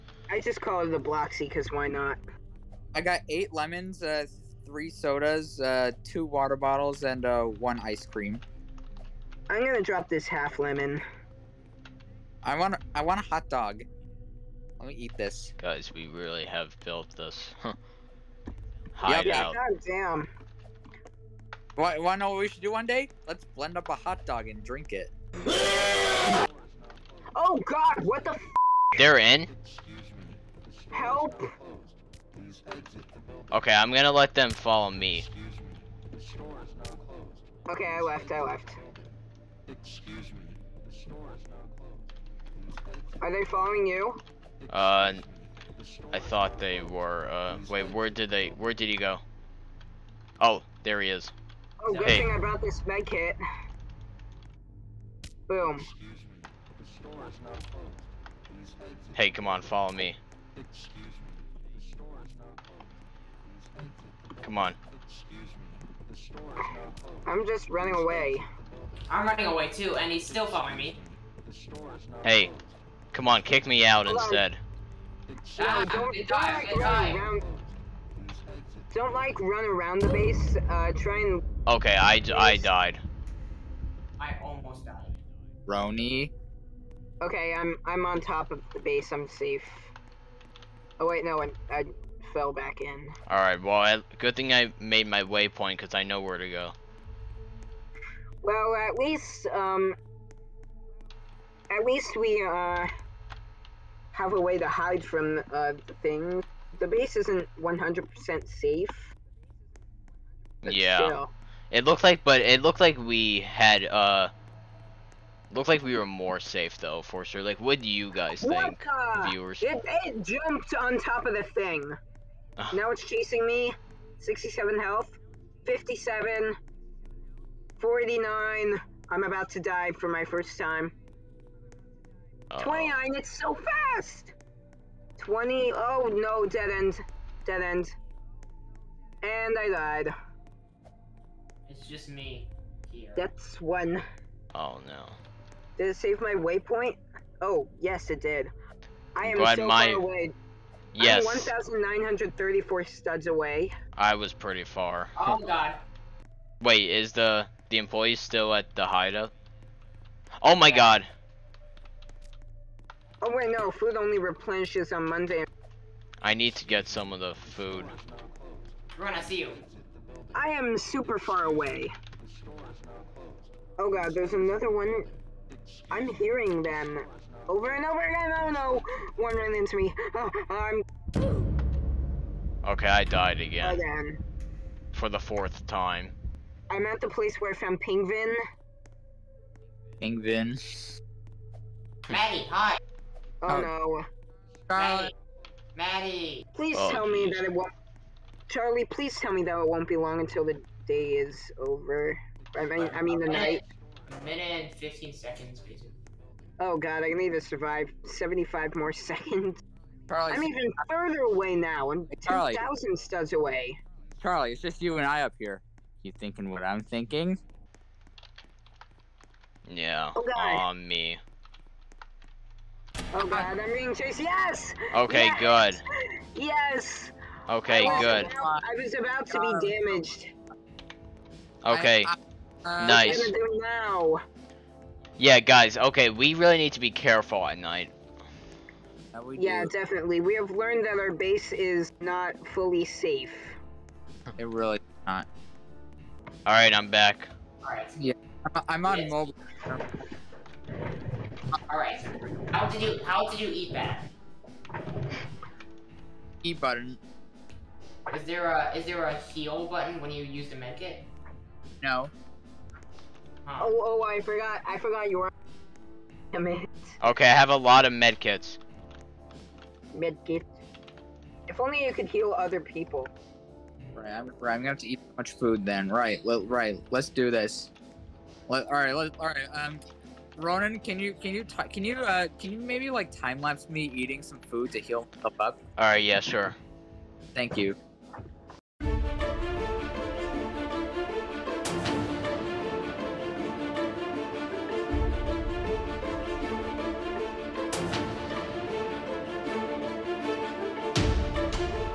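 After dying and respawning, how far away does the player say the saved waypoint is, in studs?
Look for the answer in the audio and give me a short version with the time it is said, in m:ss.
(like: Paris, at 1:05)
1,934 studs, at 2:31.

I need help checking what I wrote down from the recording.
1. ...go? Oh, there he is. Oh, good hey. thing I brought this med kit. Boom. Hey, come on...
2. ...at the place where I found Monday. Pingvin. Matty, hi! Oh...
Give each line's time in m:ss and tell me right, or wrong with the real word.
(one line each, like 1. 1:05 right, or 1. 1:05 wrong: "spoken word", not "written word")
1. 0:48 right
2. 3:06 wrong: "Pingvin", not "Monday".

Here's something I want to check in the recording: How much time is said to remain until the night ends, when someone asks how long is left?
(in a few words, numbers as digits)
A minute and 15 seconds.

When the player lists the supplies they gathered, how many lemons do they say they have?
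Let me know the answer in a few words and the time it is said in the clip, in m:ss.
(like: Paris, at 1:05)
8, at 0:03.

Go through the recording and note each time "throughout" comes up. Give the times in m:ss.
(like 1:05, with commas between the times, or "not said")
not said.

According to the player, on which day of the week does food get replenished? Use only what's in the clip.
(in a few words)
Monday.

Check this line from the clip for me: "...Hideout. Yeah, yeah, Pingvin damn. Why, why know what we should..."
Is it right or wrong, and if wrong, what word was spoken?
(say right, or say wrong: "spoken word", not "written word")
wrong: "God", not "Pingvin".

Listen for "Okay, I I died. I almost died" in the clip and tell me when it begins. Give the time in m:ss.
1:21.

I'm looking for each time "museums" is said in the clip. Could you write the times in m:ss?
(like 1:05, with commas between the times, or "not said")
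not said.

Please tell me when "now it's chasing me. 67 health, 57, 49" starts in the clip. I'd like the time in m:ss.
2:02.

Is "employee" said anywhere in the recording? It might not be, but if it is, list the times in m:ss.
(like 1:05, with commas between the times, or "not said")
2:37.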